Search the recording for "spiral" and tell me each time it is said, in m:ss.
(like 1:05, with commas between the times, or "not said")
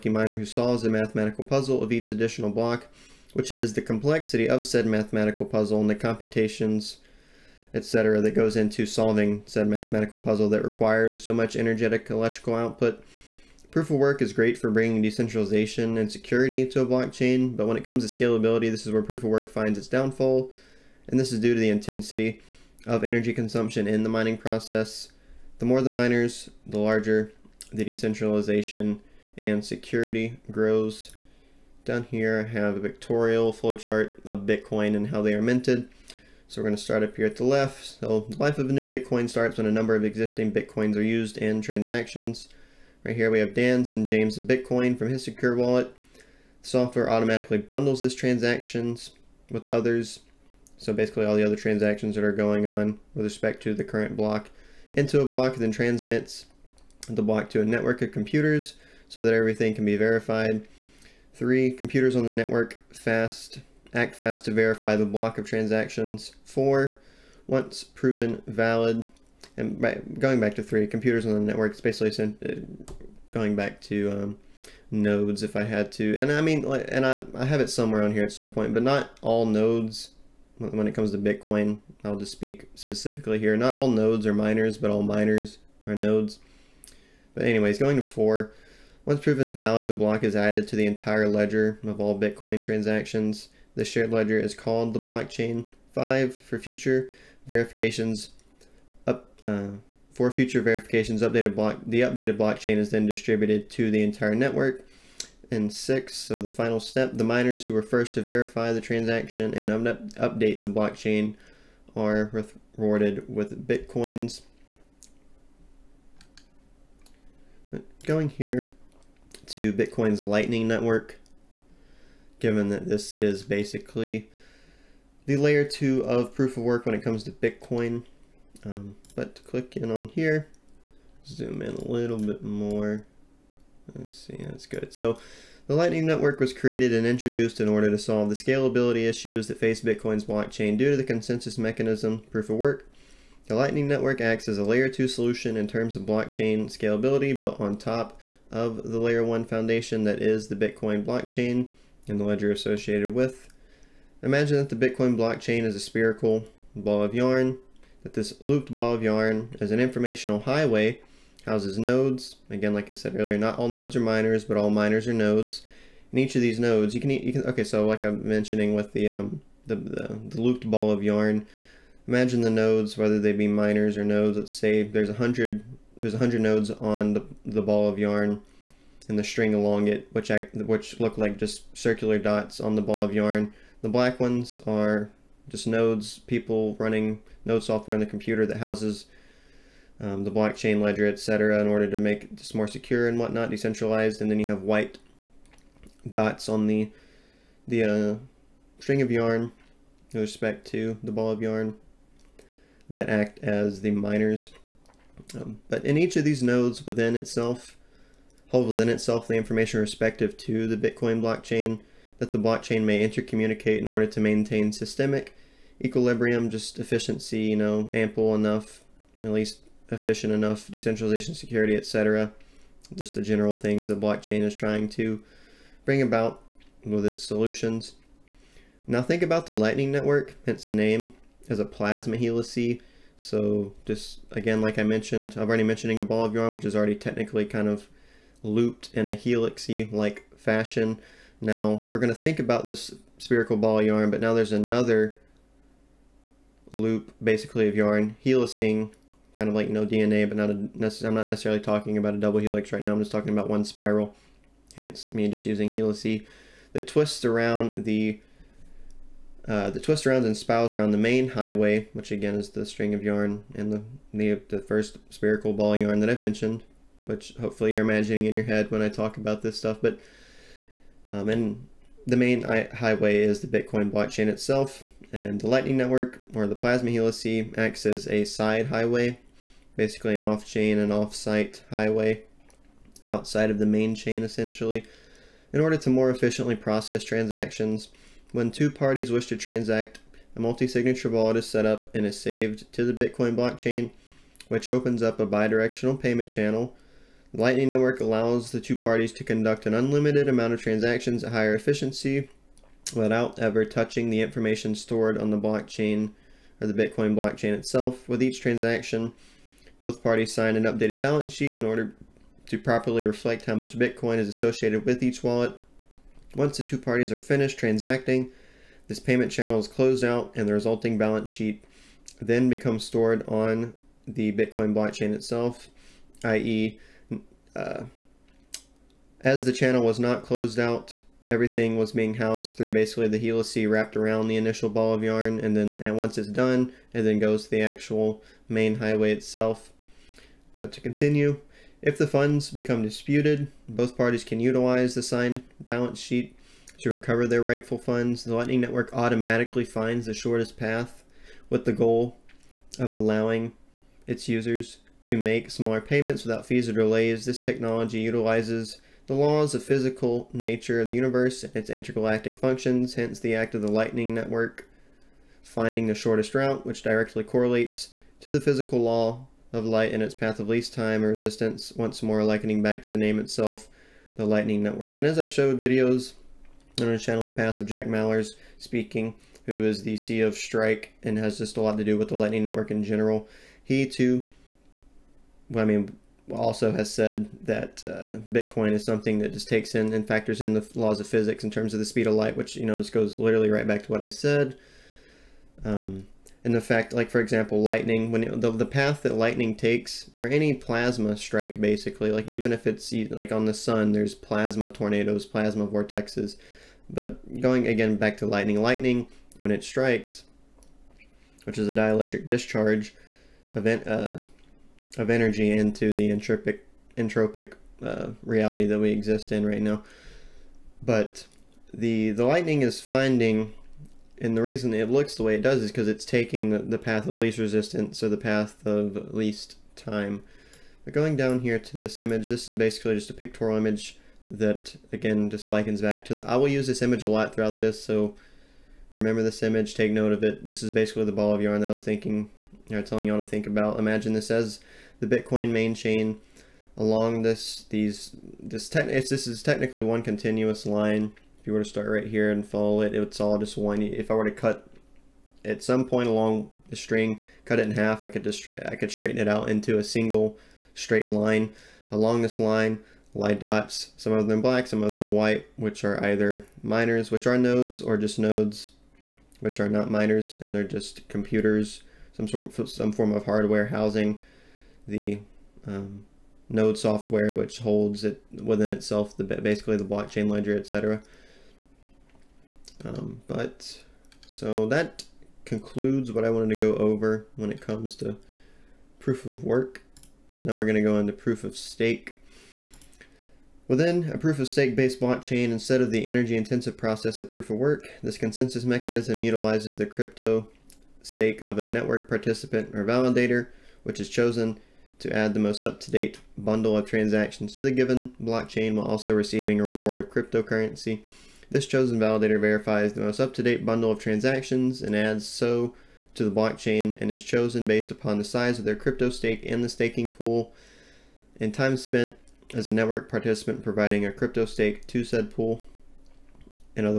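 4:13, 4:20.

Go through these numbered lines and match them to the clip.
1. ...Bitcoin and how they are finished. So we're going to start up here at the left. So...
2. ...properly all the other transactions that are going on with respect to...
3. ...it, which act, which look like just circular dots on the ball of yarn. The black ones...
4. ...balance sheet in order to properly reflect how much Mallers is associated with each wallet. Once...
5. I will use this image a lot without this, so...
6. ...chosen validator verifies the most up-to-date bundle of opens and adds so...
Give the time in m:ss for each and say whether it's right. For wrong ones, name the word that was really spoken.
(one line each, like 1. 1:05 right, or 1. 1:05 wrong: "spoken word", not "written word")
1. 0:34 wrong: "minted", not "finished"
2. 0:50 wrong: "basically", not "properly"
3. 2:59 right
4. 5:11 wrong: "Bitcoin", not "Mallers"
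5. 7:16 wrong: "throughout", not "without"
6. 8:31 wrong: "transactions", not "opens".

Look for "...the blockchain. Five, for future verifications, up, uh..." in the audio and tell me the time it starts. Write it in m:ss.
1:34.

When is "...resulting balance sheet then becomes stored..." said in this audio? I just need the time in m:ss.
5:20.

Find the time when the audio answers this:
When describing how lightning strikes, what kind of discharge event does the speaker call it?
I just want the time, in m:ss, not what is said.
6:51.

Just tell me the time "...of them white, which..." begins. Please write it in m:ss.
7:44.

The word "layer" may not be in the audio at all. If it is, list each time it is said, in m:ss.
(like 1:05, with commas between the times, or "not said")
2:05, 2:24, 2:28.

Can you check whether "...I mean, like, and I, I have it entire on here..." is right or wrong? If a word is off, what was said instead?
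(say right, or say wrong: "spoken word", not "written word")
wrong: "somewhere", not "entire".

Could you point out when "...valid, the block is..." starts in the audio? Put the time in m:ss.
1:29.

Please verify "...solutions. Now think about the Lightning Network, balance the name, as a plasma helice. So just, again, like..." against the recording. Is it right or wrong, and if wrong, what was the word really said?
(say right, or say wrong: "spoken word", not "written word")
wrong: "hence", not "balance".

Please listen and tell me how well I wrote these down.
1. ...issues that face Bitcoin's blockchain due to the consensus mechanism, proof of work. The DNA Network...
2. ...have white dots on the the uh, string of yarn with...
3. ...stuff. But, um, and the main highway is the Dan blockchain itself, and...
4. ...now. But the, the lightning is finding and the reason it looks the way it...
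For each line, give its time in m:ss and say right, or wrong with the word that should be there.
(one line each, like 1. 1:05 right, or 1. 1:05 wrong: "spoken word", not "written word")
1. 2:19 wrong: "Lightning", not "DNA"
2. 3:14 right
3. 4:29 wrong: "Bitcoin", not "Dan"
4. 6:59 right.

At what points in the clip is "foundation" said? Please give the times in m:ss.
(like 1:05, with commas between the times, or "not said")
2:29.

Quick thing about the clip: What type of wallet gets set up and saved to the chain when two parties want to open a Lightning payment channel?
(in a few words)
Multi-signature wallet.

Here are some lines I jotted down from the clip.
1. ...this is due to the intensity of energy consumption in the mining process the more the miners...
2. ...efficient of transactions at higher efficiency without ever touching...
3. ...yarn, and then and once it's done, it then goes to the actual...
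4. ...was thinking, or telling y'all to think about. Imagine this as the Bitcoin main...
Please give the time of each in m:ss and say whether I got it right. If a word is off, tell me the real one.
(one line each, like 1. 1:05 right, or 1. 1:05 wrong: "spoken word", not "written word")
1. 0:21 right
2. 5:00 wrong: "amount", not "efficient"
3. 5:35 right
4. 7:21 right.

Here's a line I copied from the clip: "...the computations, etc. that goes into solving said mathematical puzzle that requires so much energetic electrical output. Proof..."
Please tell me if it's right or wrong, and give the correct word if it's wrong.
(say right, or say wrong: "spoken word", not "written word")
right.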